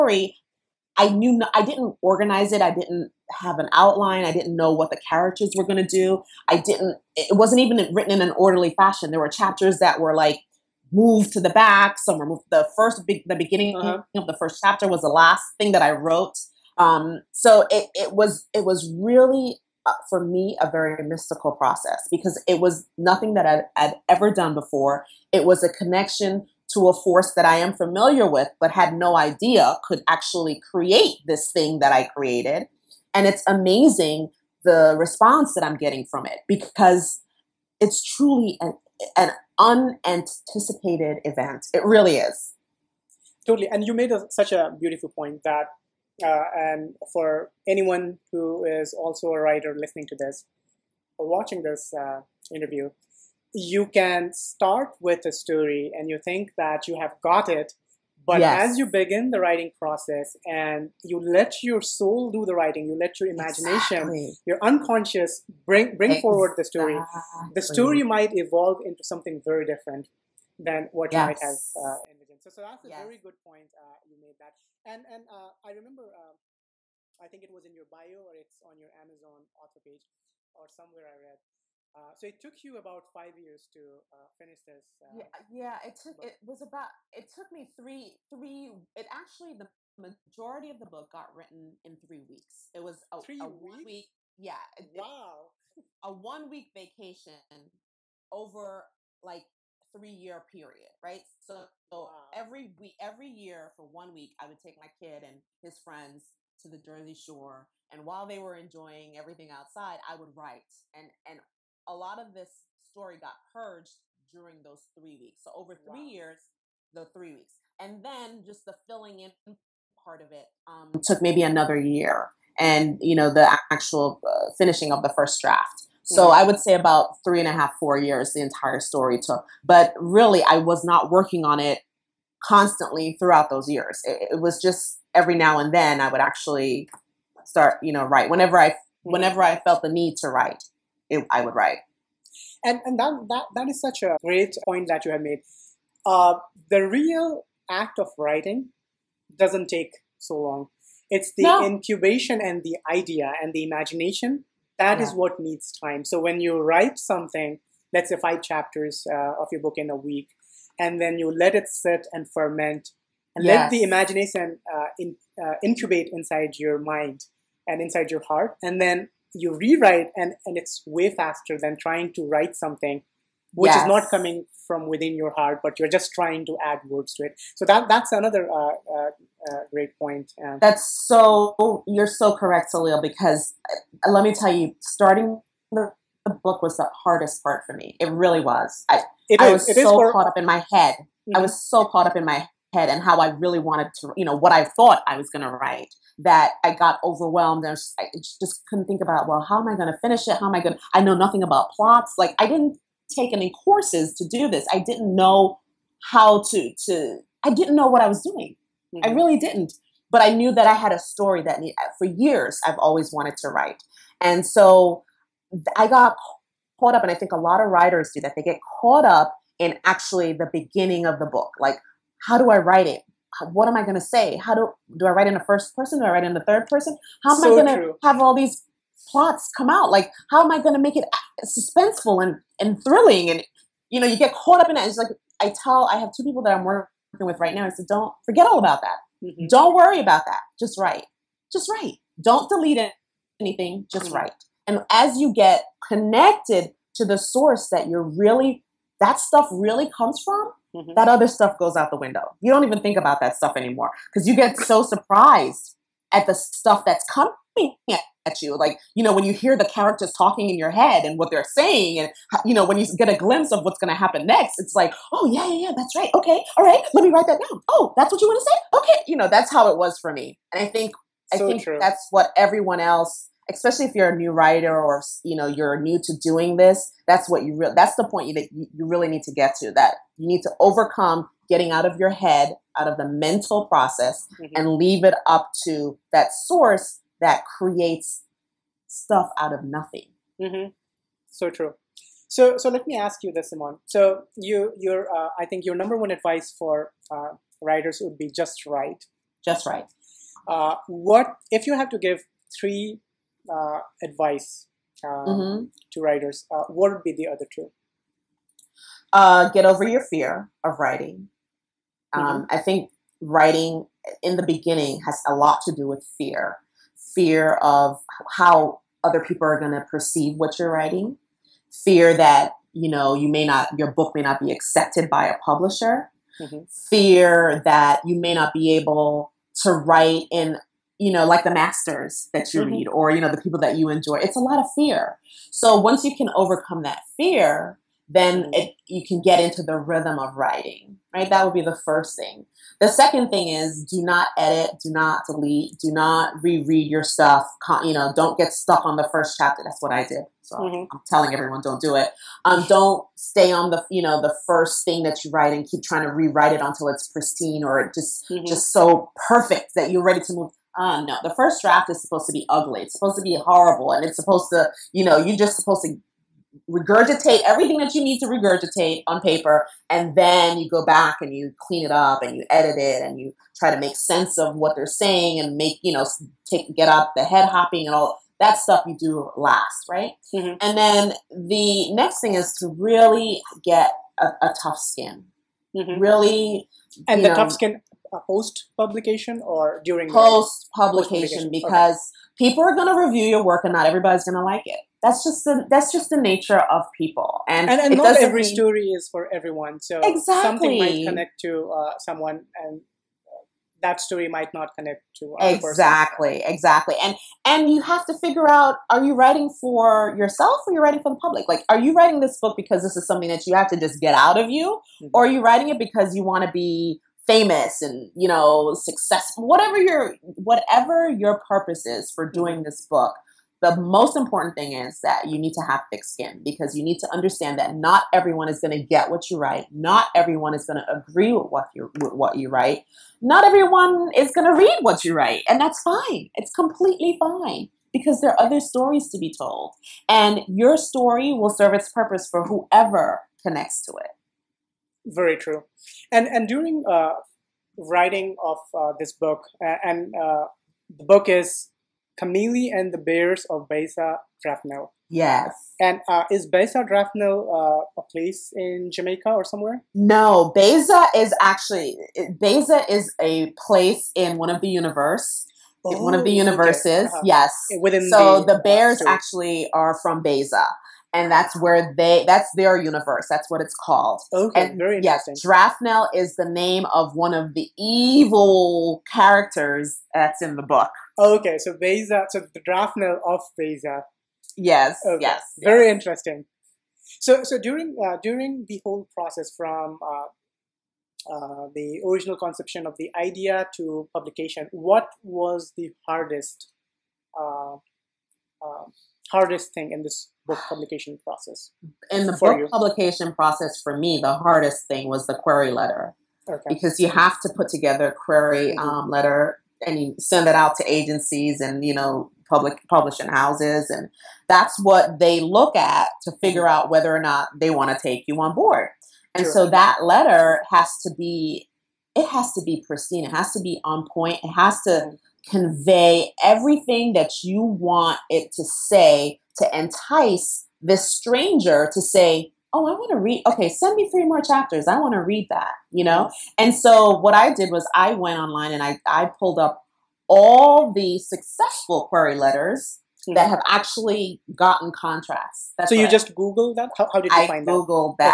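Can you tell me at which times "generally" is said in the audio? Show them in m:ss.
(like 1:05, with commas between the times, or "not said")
not said.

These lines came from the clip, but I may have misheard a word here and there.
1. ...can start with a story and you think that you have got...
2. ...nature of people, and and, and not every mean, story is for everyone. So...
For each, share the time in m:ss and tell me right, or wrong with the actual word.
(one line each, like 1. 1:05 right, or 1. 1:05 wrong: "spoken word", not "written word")
1. 0:53 right
2. 6:36 right.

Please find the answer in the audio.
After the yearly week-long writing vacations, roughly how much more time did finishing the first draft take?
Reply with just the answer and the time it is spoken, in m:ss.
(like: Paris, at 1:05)
Another year, at 2:01.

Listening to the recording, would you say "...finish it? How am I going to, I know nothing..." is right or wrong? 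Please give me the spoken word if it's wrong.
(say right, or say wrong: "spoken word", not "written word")
right.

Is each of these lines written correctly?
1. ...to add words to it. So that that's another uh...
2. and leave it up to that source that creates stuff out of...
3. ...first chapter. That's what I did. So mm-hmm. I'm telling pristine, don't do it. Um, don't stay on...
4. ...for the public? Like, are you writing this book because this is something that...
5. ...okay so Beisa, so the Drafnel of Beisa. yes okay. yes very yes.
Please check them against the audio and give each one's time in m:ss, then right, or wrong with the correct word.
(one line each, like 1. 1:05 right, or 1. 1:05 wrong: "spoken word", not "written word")
1. 2:56 right
2. 4:44 right
3. 5:49 wrong: "everyone", not "pristine"
4. 6:51 right
5. 8:01 right.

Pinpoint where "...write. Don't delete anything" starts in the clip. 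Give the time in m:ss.
4:01.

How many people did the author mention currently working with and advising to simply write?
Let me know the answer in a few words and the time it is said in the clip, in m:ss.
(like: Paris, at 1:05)
2, at 3:56.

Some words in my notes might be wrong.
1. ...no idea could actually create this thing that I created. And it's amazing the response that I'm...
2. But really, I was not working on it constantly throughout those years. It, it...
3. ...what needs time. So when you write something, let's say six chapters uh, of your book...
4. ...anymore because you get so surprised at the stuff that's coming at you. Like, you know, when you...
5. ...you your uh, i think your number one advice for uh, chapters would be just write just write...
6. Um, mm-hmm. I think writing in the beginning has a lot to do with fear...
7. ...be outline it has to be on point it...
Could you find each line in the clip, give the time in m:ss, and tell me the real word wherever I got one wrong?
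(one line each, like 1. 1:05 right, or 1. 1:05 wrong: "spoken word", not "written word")
1. 0:28 right
2. 2:09 right
3. 2:35 wrong: "five", not "six"
4. 4:13 right
5. 4:54 wrong: "writers", not "chapters"
6. 5:12 right
7. 8:42 wrong: "pristine", not "outline".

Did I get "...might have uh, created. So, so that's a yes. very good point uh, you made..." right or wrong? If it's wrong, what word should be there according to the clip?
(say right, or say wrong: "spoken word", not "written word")
wrong: "envisioned", not "created".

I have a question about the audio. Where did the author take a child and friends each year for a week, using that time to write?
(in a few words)
Jersey Shore.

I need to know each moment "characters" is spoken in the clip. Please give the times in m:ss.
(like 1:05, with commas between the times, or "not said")
0:05, 4:19, 7:59.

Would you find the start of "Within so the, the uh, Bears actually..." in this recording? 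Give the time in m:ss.
7:47.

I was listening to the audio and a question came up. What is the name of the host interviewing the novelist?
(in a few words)
Salil.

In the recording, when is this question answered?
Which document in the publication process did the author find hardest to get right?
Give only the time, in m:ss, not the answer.
8:25.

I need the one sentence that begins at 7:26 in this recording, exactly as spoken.
And and during uh, writing of uh, this book, and uh, the book is Camille and the Bears of Beisa Drafnel.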